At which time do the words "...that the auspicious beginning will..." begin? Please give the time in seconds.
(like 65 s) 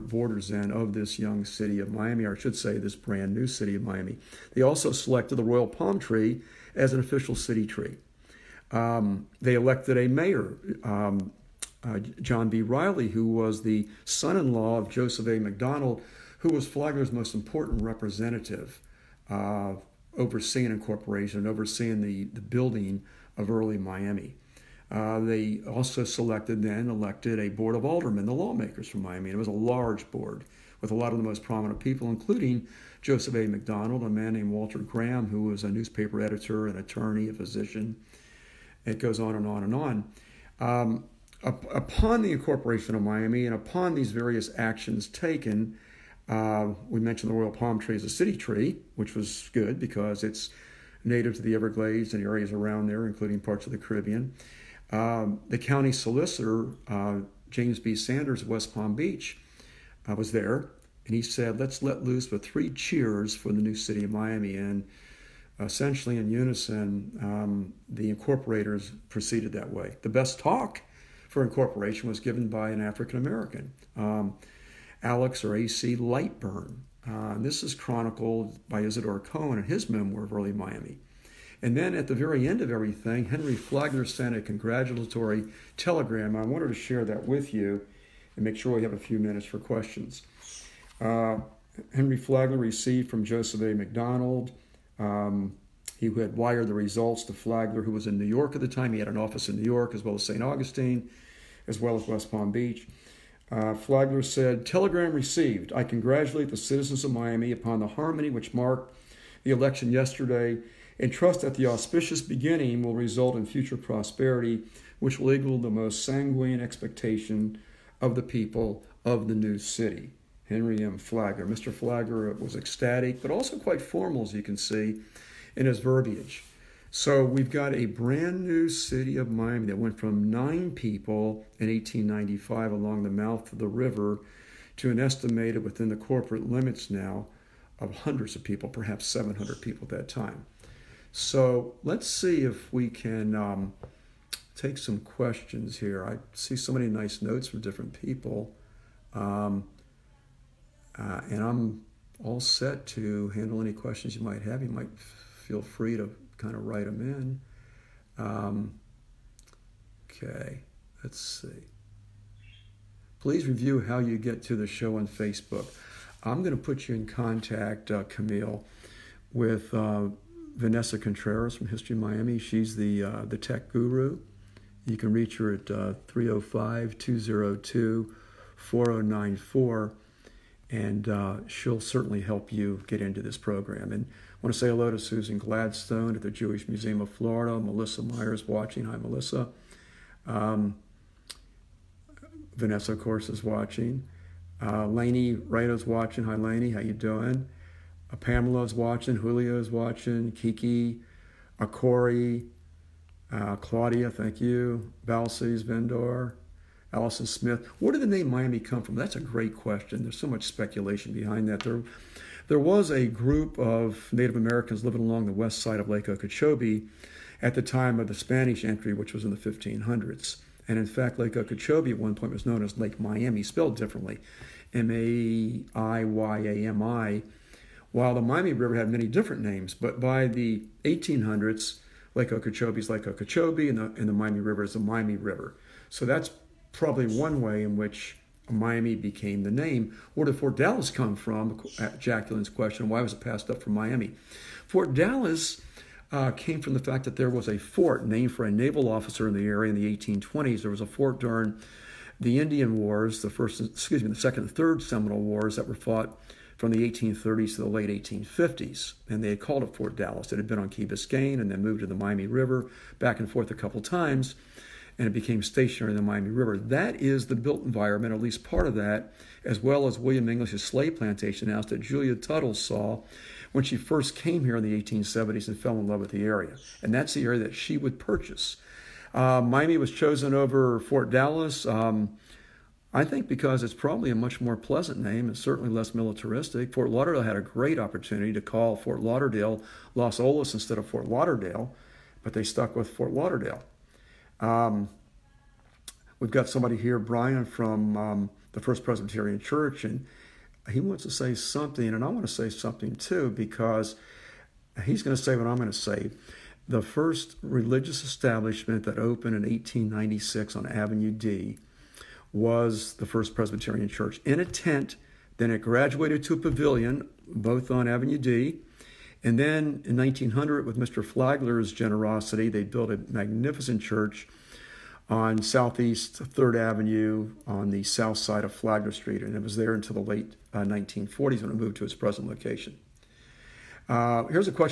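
111 s.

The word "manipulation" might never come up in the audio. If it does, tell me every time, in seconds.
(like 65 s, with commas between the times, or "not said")
not said.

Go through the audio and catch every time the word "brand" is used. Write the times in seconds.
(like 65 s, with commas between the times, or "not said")
2 s, 127 s.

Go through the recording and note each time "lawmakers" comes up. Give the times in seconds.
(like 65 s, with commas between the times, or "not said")
28 s.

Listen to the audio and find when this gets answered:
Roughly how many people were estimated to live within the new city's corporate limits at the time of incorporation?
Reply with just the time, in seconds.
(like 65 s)
139 s.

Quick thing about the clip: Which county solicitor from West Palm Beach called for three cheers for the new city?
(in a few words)
James B. Sanders.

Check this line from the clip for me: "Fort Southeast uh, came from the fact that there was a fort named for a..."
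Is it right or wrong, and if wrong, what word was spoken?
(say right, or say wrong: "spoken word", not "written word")
wrong: "Dallas", not "Southeast".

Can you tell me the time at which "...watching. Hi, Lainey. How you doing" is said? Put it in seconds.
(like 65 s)
195 s.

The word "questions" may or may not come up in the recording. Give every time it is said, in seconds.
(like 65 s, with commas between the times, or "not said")
89 s, 144 s, 153 s, 209 s, 242 s.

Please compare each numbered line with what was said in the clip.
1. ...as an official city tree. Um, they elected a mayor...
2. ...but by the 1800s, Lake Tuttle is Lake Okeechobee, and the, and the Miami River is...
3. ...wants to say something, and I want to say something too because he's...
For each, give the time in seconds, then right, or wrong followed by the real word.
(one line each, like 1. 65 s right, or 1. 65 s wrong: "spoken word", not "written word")
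1. 6 s right
2. 229 s wrong: "Okeechobee", not "Tuttle"
3. 300 s right.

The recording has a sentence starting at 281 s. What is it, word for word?
Um, I think because it's probably a much more pleasant name and certainly less militaristic.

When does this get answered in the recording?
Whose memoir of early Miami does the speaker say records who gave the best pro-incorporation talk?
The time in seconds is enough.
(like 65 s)
78 s.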